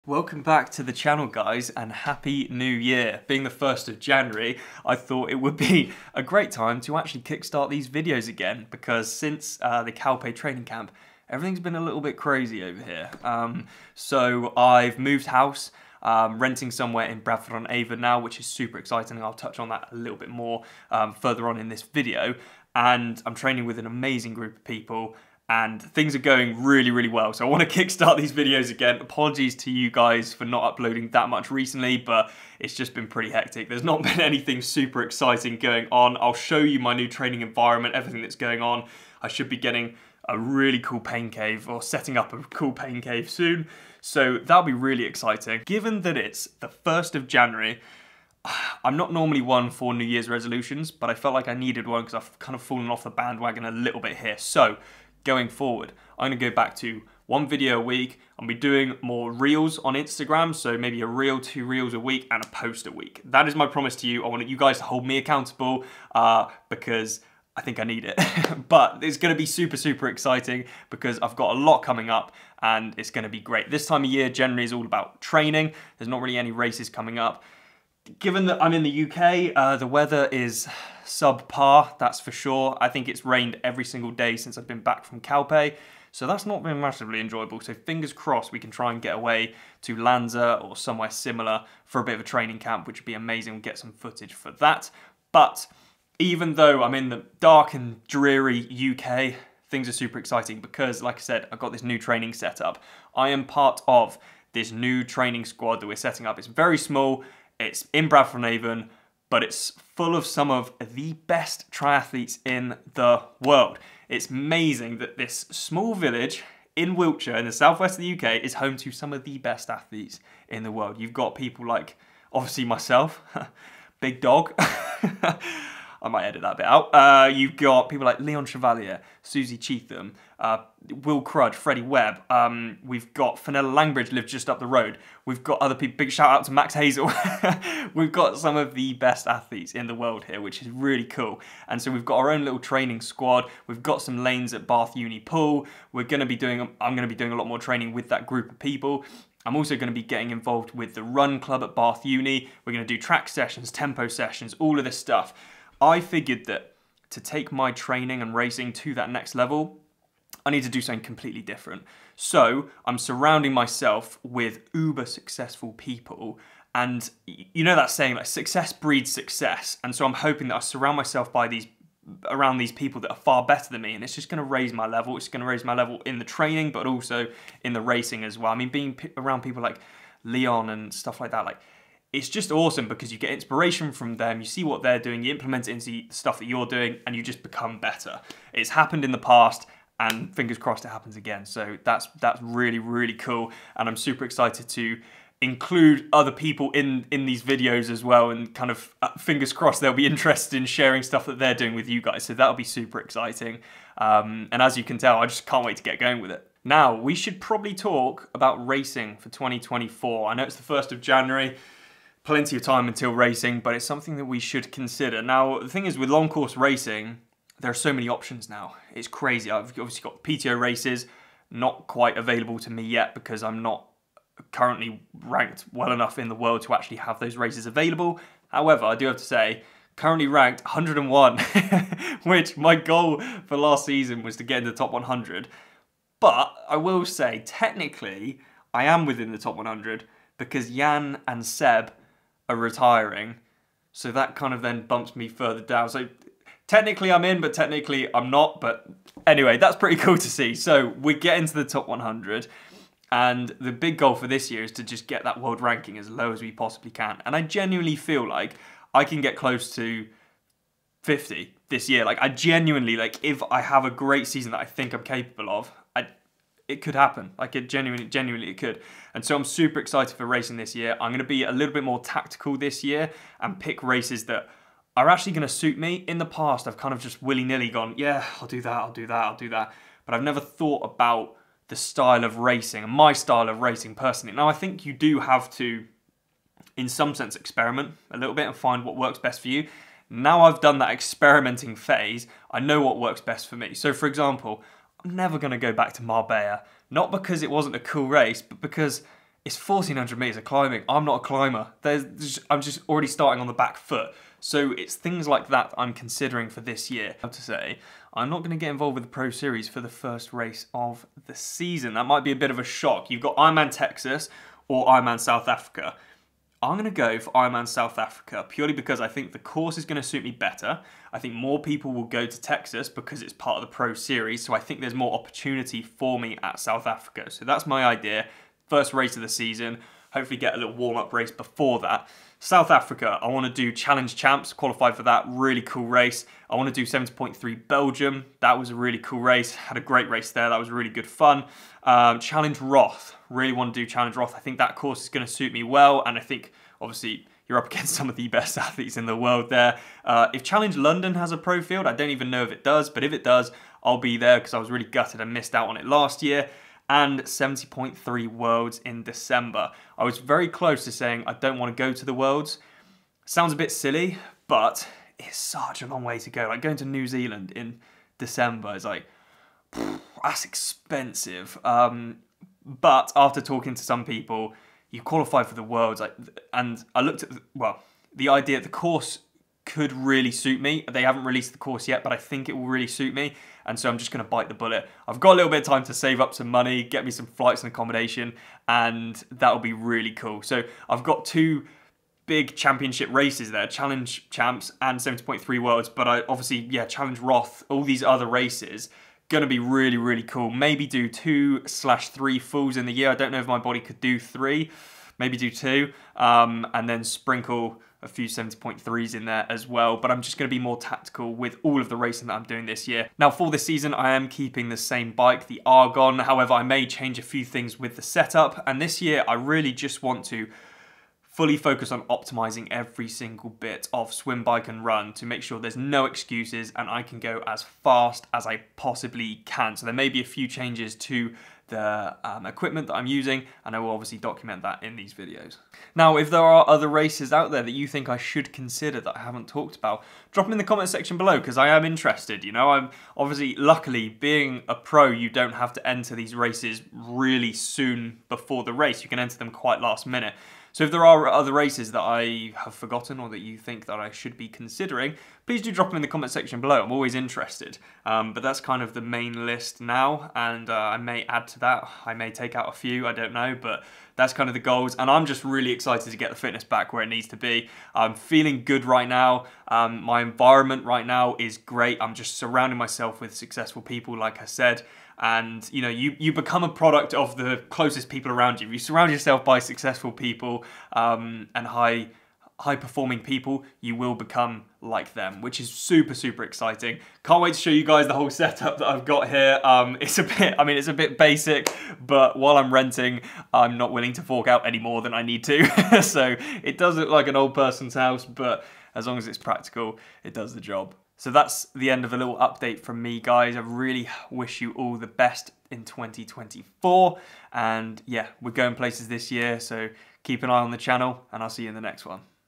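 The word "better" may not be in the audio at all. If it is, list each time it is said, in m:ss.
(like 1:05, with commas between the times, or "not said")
2:53, 3:07, 5:20.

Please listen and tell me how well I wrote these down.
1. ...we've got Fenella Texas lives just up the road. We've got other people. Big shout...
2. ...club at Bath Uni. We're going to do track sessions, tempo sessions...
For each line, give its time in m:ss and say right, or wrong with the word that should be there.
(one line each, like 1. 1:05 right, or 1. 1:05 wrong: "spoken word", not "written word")
1. 2:12 wrong: "Langridge", not "Texas"
2. 2:31 right.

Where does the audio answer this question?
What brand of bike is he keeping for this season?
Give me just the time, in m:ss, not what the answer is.
6:55.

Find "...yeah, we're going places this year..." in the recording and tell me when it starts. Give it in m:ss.
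8:28.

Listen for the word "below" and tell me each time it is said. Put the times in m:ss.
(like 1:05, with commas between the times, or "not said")
7:21, 7:36.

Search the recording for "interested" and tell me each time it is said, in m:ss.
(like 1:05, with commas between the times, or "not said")
3:20, 7:21, 7:37.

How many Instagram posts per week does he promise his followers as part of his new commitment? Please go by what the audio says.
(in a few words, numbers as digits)
a post a week.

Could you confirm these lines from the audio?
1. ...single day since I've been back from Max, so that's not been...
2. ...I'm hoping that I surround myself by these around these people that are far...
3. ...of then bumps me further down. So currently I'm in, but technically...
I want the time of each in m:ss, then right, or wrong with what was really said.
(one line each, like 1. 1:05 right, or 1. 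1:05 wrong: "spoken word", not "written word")
1. 1:23 wrong: "Calpe", not "Max"
2. 2:50 right
3. 4:04 wrong: "technically", not "currently".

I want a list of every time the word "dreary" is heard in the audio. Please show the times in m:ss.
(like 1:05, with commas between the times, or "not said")
1:38.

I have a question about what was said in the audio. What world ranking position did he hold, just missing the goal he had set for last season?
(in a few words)
101.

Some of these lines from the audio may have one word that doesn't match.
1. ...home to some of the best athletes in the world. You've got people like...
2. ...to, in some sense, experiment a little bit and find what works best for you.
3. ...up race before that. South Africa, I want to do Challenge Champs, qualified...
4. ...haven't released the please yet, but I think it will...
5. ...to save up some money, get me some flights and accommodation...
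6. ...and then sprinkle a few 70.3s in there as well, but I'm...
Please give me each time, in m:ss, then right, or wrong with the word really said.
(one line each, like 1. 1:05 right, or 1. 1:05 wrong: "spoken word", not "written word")
1. 1:58 right
2. 4:45 right
3. 5:30 right
4. 6:21 wrong: "course", not "please"
5. 6:25 right
6. 6:46 right.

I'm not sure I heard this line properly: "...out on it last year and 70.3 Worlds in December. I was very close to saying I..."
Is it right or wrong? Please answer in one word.
right.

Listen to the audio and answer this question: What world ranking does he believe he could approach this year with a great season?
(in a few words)
50.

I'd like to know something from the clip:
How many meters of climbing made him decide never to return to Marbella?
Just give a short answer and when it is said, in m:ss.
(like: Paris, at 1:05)
1400, at 4:59.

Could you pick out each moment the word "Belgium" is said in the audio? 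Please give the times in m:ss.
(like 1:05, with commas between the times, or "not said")
5:37.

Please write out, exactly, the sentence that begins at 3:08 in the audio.
It's happened in the past, and fingers crossed it happens again.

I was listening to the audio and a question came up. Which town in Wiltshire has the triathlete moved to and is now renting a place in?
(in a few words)
Bradford on Avon.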